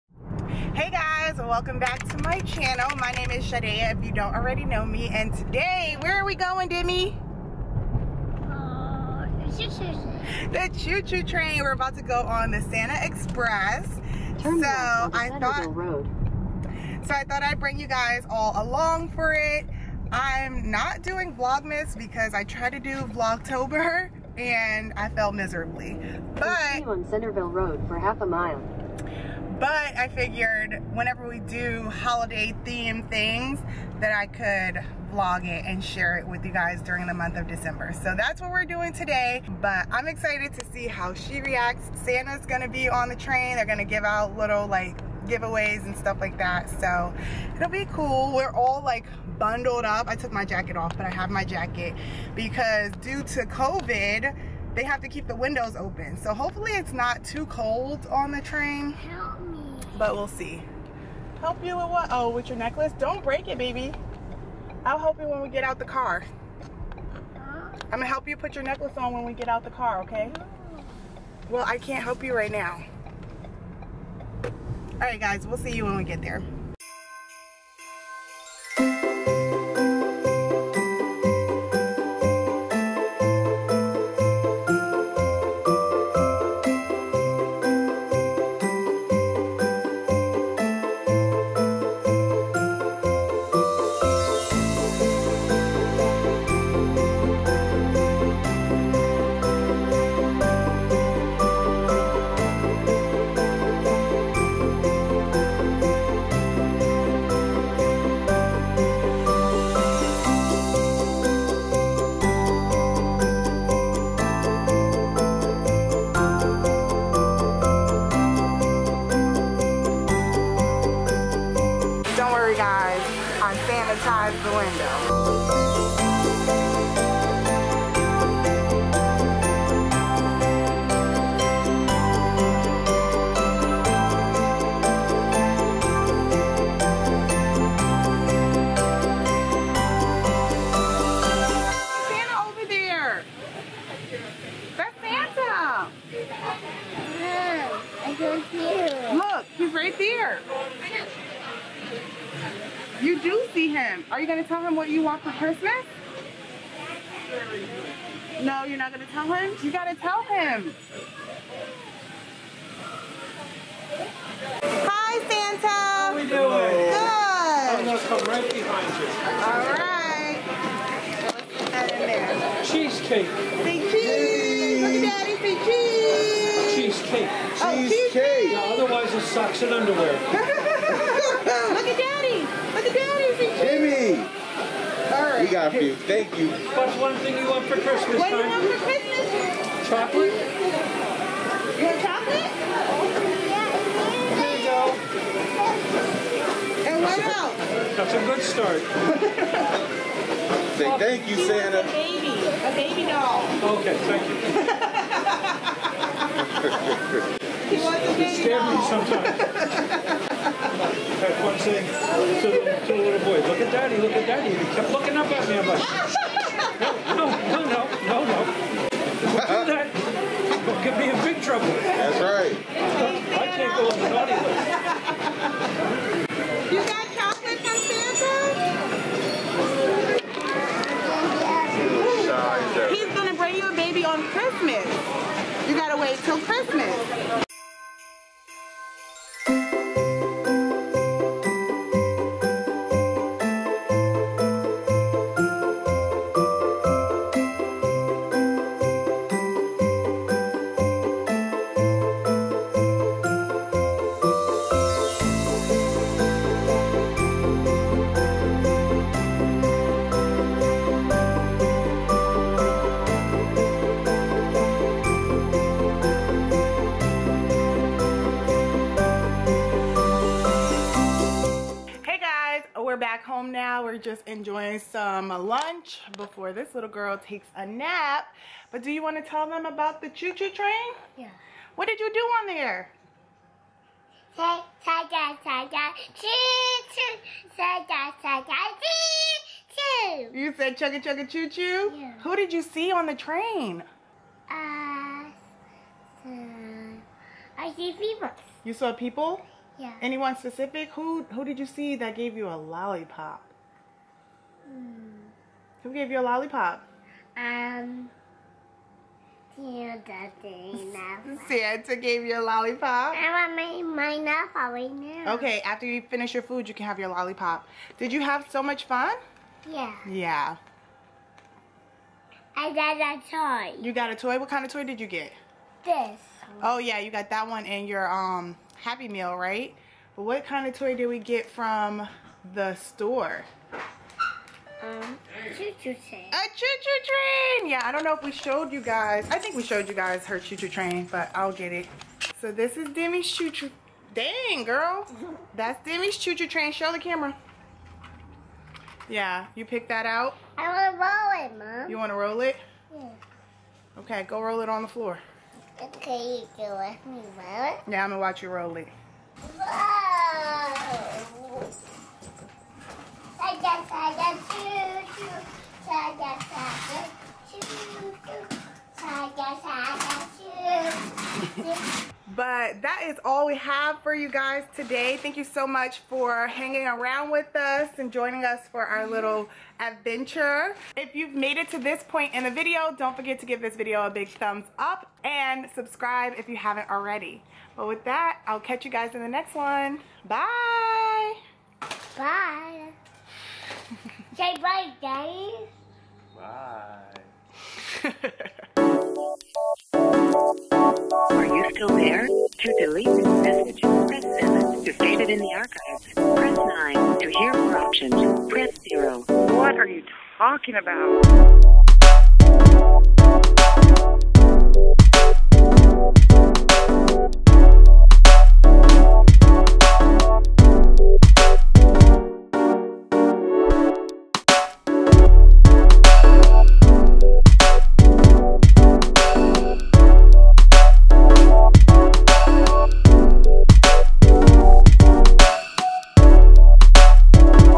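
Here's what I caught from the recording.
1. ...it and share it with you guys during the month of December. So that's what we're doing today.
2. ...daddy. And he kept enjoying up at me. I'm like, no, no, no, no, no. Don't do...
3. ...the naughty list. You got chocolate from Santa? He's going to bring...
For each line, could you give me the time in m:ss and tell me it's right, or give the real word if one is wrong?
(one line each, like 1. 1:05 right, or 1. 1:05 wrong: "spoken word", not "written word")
1. 0:35 right
2. 3:34 wrong: "looking", not "enjoying"
3. 3:43 right.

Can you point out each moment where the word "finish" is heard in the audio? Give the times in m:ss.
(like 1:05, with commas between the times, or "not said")
5:16.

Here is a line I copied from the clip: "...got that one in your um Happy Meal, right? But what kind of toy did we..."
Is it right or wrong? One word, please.
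right.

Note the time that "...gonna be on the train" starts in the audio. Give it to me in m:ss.
0:42.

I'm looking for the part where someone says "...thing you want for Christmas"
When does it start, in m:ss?
3:07.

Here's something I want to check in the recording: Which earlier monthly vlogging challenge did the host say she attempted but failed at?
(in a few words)
Vlogtober.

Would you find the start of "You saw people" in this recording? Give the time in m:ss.
4:58.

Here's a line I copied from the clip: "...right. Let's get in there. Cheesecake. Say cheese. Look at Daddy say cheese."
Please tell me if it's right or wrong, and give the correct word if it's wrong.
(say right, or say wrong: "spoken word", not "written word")
right.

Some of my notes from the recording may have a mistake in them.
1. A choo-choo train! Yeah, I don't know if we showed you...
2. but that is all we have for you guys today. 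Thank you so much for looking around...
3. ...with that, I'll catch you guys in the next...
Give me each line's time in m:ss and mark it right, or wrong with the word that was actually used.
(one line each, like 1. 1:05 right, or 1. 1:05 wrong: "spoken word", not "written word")
1. 5:36 right
2. 6:12 wrong: "hanging", not "looking"
3. 6:27 right.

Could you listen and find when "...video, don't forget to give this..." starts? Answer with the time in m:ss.
6:22.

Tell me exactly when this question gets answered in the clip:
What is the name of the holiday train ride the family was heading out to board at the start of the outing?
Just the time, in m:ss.
0:12.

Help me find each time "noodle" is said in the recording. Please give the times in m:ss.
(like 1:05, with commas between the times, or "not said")
not said.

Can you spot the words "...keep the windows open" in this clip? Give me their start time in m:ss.
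0:55.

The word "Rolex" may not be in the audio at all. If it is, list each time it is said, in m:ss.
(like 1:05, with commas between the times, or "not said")
not said.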